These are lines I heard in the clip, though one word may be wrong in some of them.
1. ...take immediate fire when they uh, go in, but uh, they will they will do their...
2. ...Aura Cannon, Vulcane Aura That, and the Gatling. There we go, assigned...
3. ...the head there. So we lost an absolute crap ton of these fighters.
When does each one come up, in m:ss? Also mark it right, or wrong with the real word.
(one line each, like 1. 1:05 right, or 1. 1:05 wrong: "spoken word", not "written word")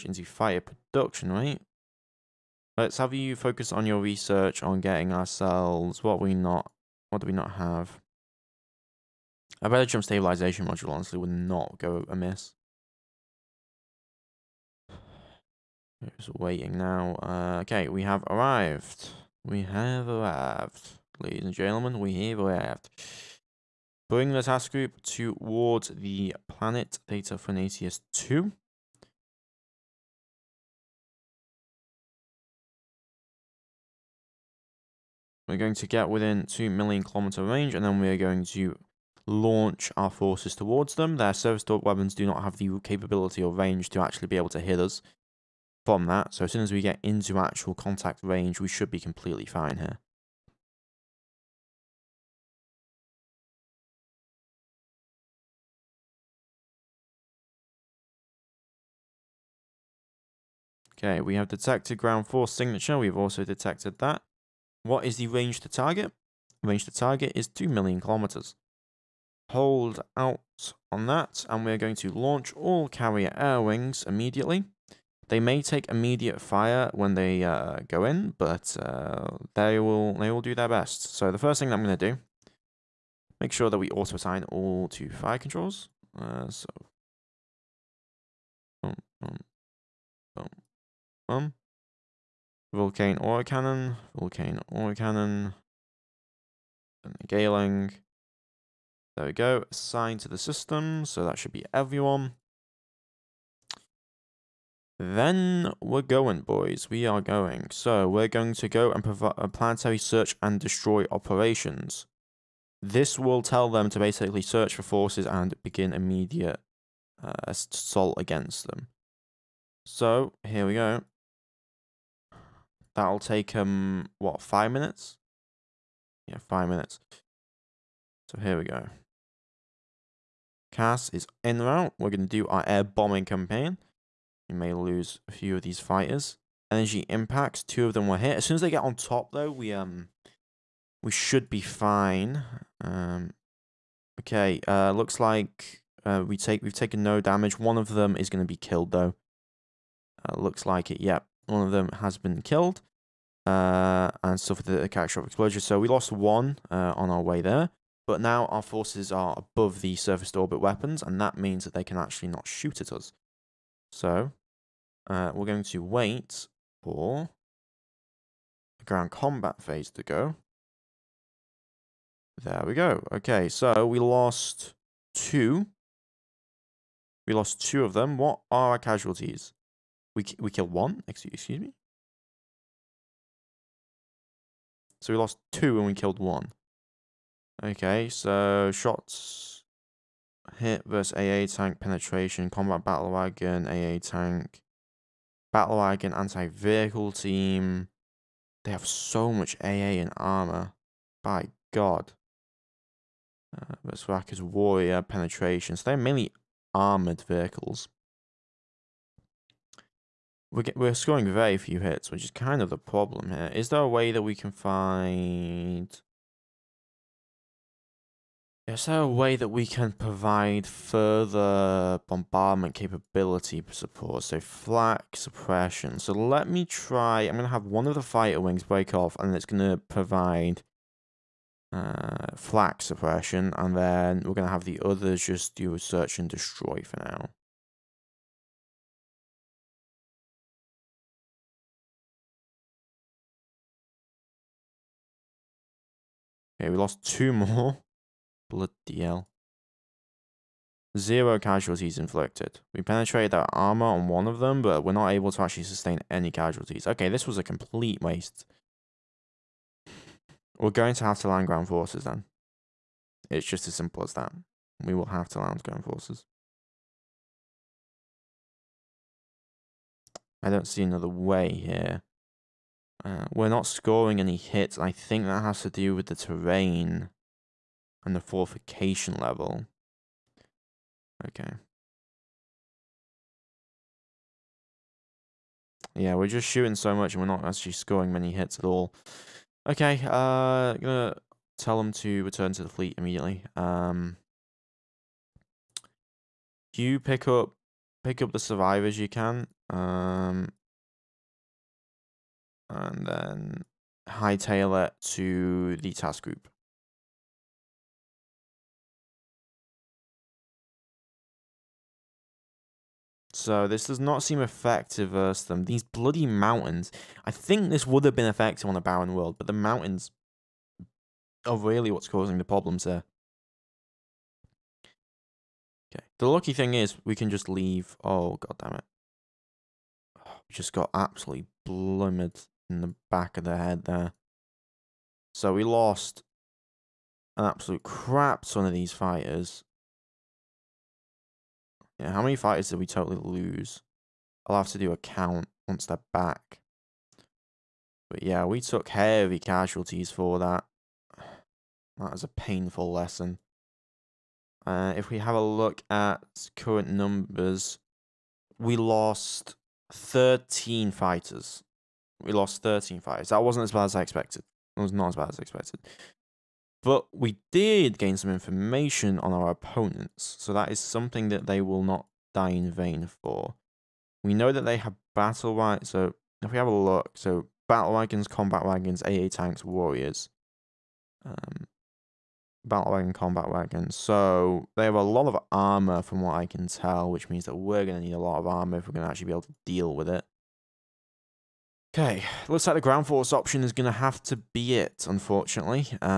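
1. 1:15 right
2. 1:33 wrong: "Cannon", not "That"
3. 5:33 right.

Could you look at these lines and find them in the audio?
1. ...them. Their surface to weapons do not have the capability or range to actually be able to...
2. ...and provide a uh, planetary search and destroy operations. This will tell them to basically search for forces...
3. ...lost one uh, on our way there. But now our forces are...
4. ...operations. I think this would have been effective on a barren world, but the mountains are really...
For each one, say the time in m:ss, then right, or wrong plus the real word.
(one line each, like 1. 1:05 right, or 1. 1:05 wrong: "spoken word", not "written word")
1. 0:40 right
2. 1:48 right
3. 2:35 right
4. 5:16 wrong: "mountains", not "operations".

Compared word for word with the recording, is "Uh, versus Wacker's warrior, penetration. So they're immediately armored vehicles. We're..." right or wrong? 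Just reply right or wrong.
wrong.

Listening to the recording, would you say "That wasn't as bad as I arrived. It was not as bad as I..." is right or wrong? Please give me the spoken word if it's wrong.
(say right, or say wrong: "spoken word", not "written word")
wrong: "expected", not "arrived".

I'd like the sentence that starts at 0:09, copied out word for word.
A better jump stabilization module honestly would not go amiss.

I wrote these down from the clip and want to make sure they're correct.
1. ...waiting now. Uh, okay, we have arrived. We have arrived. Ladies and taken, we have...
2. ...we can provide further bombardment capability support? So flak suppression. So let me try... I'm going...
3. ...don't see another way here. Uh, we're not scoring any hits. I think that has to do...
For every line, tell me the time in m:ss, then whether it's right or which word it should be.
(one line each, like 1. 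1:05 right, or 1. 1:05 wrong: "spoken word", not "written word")
1. 0:16 wrong: "gentlemen", not "taken"
2. 3:39 right
3. 4:30 right.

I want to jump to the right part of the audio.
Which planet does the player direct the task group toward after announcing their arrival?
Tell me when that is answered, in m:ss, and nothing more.
0:27.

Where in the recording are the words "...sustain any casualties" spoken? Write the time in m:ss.
4:15.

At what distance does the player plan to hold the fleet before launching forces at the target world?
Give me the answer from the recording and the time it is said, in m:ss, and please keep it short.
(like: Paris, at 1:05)
2 million kilometers, at 1:07.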